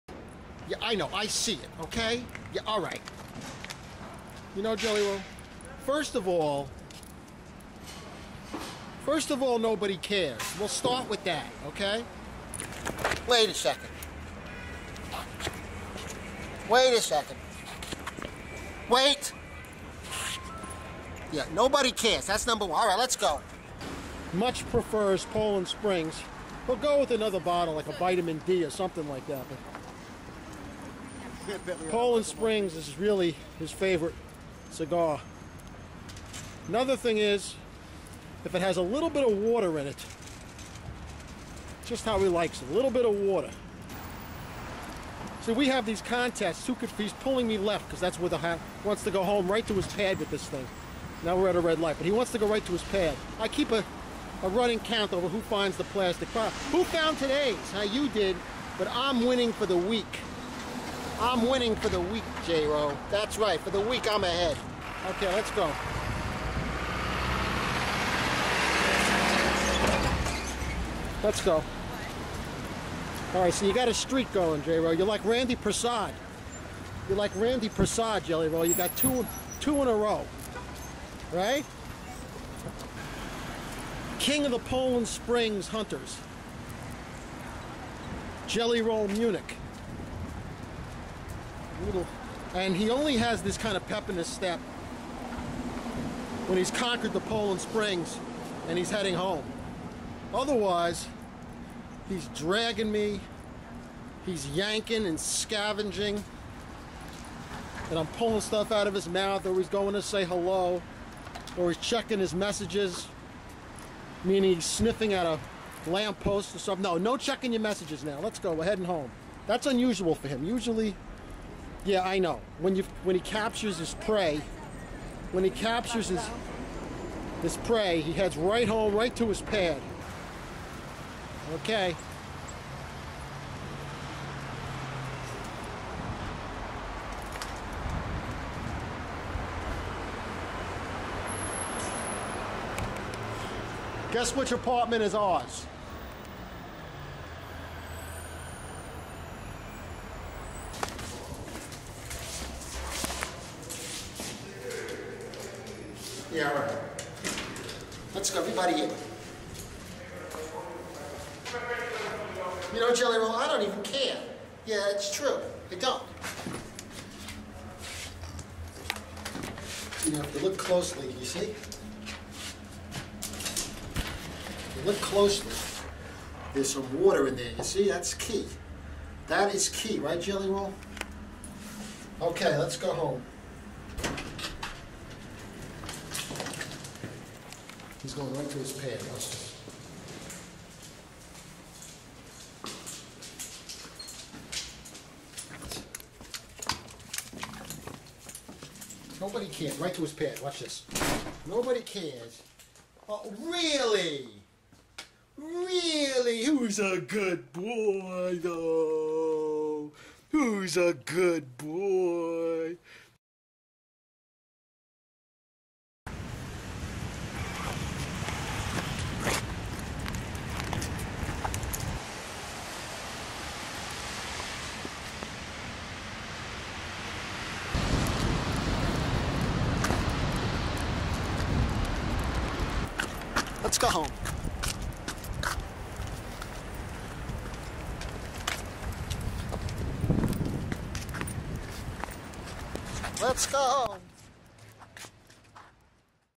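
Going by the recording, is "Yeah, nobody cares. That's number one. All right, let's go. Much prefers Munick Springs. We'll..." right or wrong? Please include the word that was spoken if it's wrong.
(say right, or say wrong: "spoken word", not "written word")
wrong: "Poland", not "Munick".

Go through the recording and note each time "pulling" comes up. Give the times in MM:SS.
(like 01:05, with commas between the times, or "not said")
00:47, 01:48.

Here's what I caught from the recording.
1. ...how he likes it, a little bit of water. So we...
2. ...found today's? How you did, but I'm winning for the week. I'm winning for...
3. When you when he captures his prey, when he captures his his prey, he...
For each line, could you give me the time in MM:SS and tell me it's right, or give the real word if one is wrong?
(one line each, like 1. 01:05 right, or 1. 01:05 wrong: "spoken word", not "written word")
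1. 00:42 right
2. 00:56 right
3. 02:02 right.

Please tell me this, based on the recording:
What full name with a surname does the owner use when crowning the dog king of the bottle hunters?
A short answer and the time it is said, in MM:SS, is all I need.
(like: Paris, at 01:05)
Jelly Roll Munick, at 01:28.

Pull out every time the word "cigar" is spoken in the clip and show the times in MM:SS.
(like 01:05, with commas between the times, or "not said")
00:34.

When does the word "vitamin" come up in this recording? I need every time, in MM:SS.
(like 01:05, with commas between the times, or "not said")
00:27.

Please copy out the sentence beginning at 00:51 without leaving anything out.
Now we're at a red light, but he wants to go right to his pad.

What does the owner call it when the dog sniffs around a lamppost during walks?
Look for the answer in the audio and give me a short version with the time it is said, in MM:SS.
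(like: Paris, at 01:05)
checking his messages, at 01:51.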